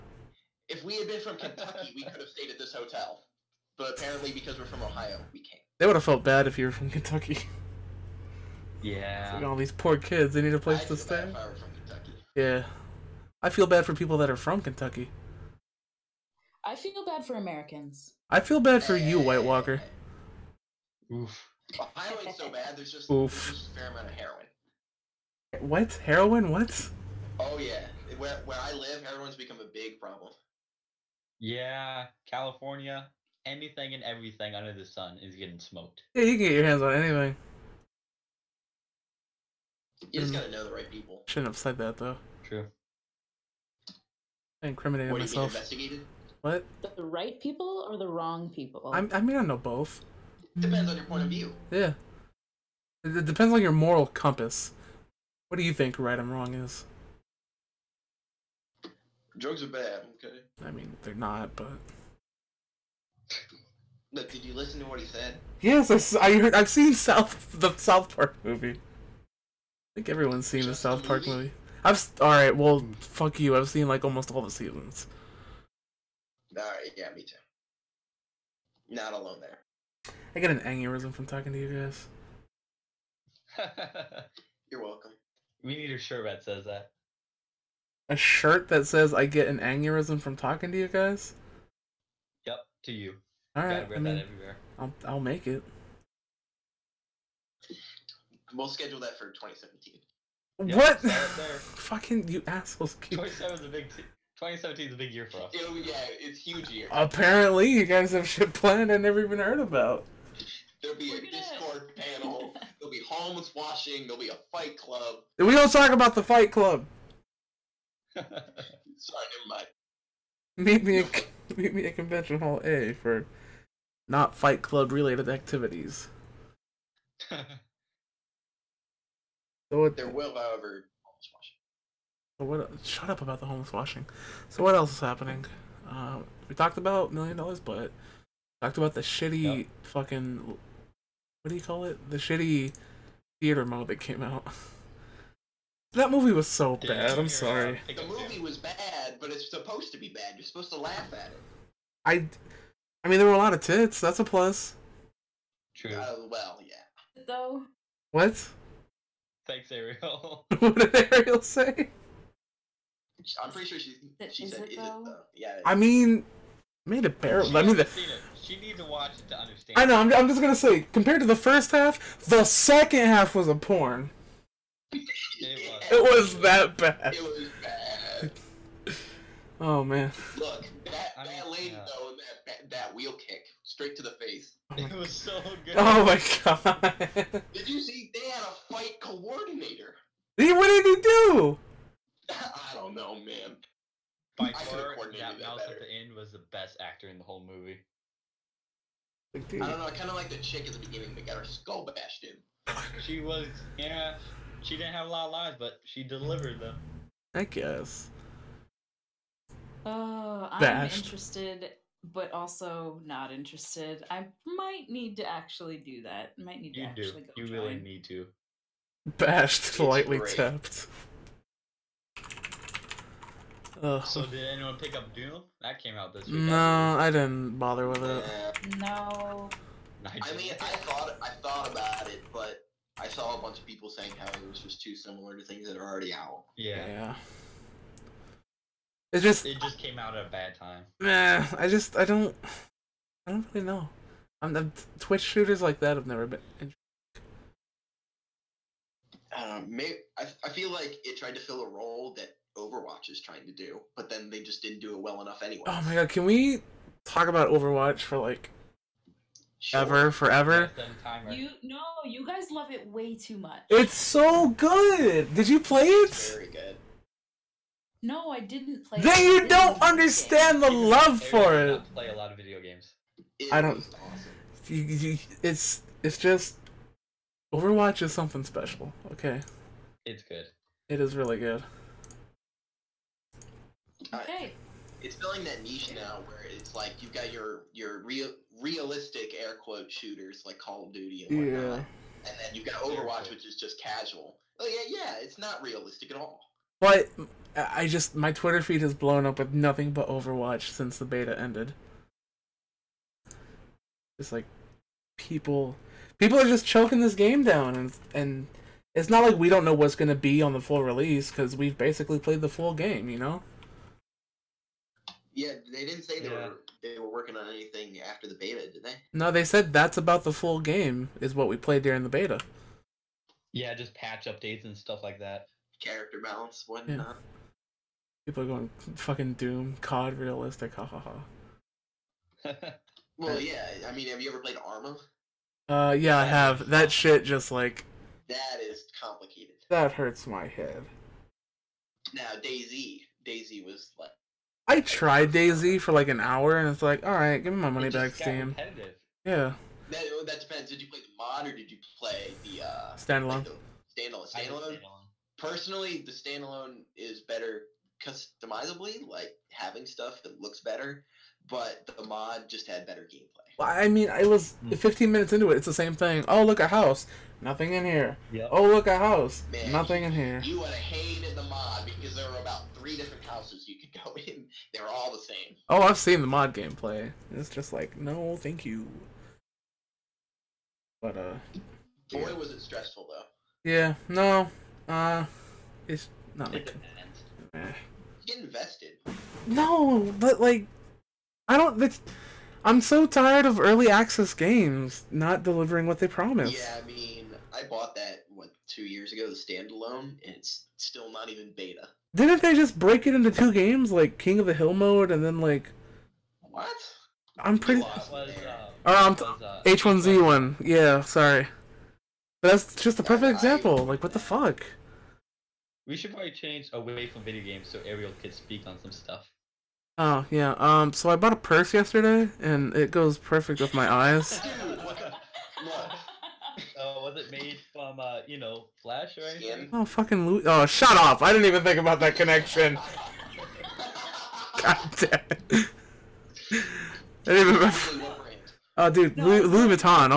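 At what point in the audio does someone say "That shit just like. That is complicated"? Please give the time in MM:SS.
05:36.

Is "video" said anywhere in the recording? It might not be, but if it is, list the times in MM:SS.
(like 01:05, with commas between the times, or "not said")
04:32, 06:57.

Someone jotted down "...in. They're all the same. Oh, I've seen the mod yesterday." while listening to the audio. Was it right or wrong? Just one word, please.
wrong.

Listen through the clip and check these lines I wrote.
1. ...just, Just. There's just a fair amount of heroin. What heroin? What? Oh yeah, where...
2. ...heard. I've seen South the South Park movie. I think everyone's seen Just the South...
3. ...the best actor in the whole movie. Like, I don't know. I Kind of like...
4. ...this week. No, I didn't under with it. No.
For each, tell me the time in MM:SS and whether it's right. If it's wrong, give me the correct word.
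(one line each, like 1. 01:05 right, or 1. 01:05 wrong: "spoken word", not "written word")
1. 00:22 wrong: "Oof", not "Just"
2. 01:06 right
3. 03:16 right
4. 03:46 wrong: "bother", not "under".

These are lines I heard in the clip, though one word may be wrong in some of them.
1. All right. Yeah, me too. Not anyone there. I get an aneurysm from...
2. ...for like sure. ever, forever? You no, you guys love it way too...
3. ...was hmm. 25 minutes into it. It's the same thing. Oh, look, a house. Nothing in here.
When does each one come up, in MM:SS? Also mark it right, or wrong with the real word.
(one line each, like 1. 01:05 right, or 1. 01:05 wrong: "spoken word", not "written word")
1. 01:16 wrong: "alone", not "anyone"
2. 04:18 right
3. 06:04 wrong: "15", not "25".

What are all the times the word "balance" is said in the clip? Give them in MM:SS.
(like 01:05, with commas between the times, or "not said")
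05:26.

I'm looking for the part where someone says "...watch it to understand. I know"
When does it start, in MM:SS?
02:48.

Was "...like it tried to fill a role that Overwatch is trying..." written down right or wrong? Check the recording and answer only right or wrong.
right.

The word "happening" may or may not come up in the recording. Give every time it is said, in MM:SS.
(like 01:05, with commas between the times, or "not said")
02:14.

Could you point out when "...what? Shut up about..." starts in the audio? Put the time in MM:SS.
02:12.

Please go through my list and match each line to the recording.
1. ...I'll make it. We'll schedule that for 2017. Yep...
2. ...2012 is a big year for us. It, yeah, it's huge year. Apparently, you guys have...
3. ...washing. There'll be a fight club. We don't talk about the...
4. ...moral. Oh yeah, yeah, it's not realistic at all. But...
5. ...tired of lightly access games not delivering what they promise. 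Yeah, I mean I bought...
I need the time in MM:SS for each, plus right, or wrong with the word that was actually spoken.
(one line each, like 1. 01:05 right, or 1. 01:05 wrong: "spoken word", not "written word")
1. 01:35 right
2. 01:44 wrong: "2017", not "2012"
3. 01:53 right
4. 04:53 wrong: "casual", not "moral"
5. 06:33 wrong: "early", not "lightly".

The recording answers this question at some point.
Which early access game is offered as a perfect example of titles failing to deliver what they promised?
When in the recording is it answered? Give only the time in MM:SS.
06:49.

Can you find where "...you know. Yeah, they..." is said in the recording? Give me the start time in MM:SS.
05:13.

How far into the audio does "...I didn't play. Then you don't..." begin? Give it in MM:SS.
04:28.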